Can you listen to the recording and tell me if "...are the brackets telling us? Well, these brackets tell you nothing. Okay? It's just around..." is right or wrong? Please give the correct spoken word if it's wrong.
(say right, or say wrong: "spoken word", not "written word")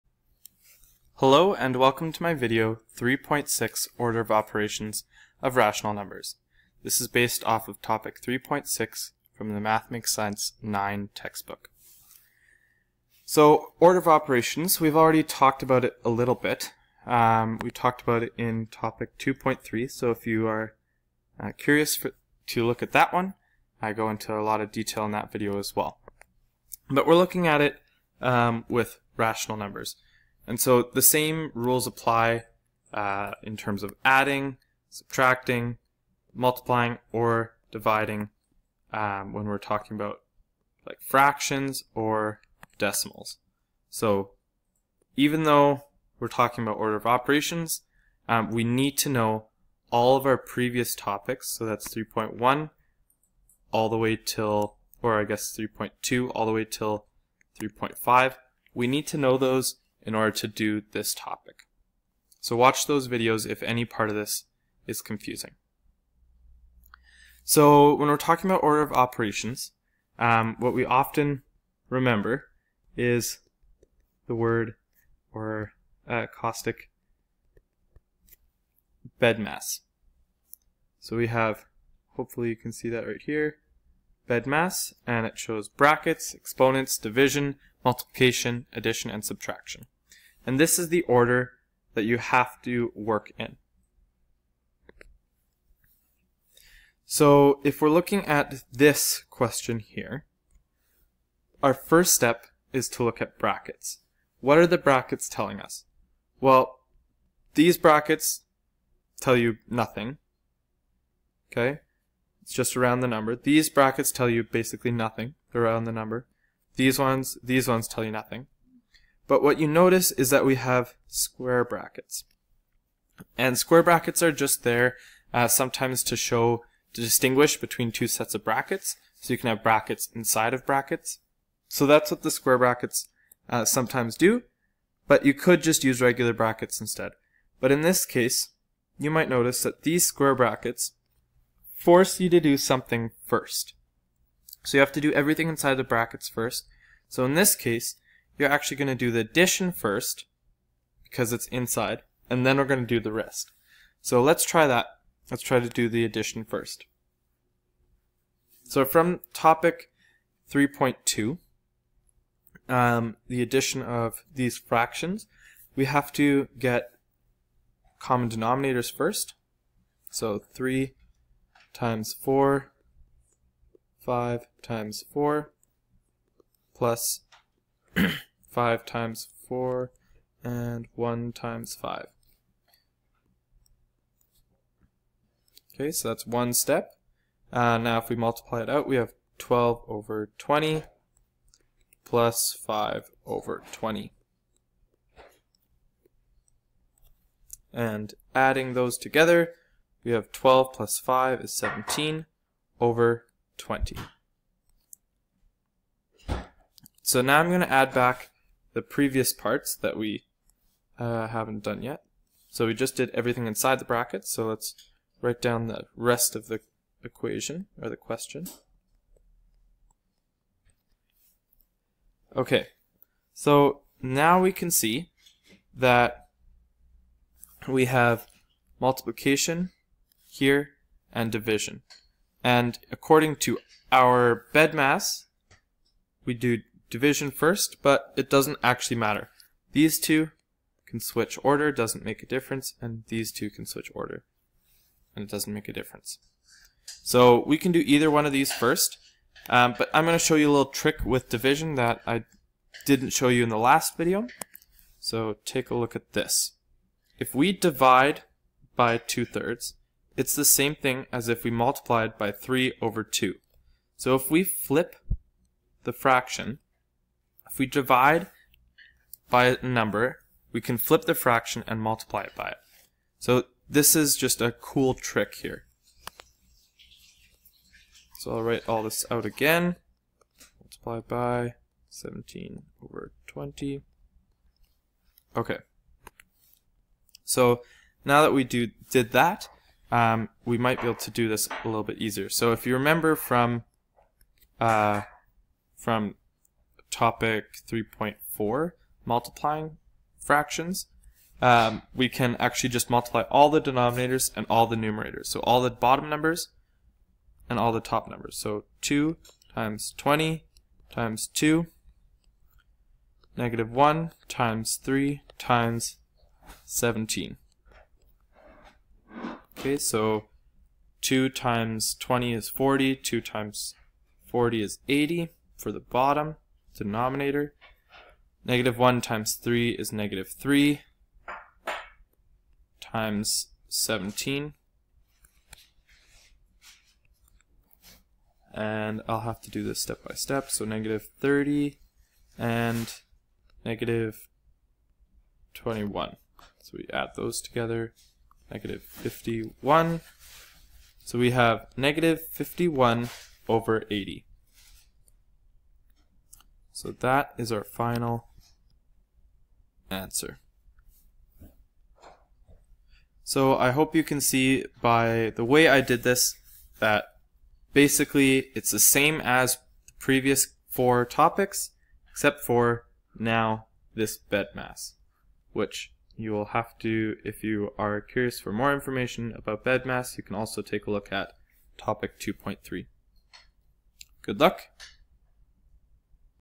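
right.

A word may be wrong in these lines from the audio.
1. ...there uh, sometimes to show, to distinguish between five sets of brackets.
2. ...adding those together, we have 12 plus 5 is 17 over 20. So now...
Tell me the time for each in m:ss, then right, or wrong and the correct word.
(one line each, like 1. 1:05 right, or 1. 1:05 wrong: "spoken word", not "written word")
1. 2:04 wrong: "two", not "five"
2. 3:18 right.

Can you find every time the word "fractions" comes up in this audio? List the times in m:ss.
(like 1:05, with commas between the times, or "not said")
0:41, 2:44, 4:25, 4:31, 5:00.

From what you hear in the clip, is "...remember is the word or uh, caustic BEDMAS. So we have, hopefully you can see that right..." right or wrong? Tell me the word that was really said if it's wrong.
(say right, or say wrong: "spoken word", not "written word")
right.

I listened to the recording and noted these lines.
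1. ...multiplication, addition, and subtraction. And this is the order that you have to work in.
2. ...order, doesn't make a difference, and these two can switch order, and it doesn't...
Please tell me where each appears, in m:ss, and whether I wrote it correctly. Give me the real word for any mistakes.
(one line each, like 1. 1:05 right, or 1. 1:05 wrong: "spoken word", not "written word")
1. 1:27 right
2. 4:01 right.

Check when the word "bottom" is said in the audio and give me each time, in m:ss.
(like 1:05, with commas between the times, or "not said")
5:05, 5:25.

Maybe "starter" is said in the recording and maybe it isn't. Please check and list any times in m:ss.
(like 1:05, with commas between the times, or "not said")
not said.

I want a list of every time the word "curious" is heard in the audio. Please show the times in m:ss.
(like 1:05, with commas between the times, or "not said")
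0:21, 6:17.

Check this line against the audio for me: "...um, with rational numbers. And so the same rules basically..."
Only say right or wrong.
wrong.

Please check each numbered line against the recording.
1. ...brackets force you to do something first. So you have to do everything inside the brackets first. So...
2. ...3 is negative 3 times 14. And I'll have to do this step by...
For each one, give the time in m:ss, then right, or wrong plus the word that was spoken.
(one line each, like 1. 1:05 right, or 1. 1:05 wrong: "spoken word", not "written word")
1. 2:20 right
2. 5:29 wrong: "17", not "14".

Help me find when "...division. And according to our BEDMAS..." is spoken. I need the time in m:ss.
3:51.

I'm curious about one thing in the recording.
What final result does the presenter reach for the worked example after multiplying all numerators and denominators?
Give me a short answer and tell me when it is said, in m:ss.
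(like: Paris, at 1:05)
-51/80, at 5:51.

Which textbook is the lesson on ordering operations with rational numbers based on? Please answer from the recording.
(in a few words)
Math Makes Sense 9.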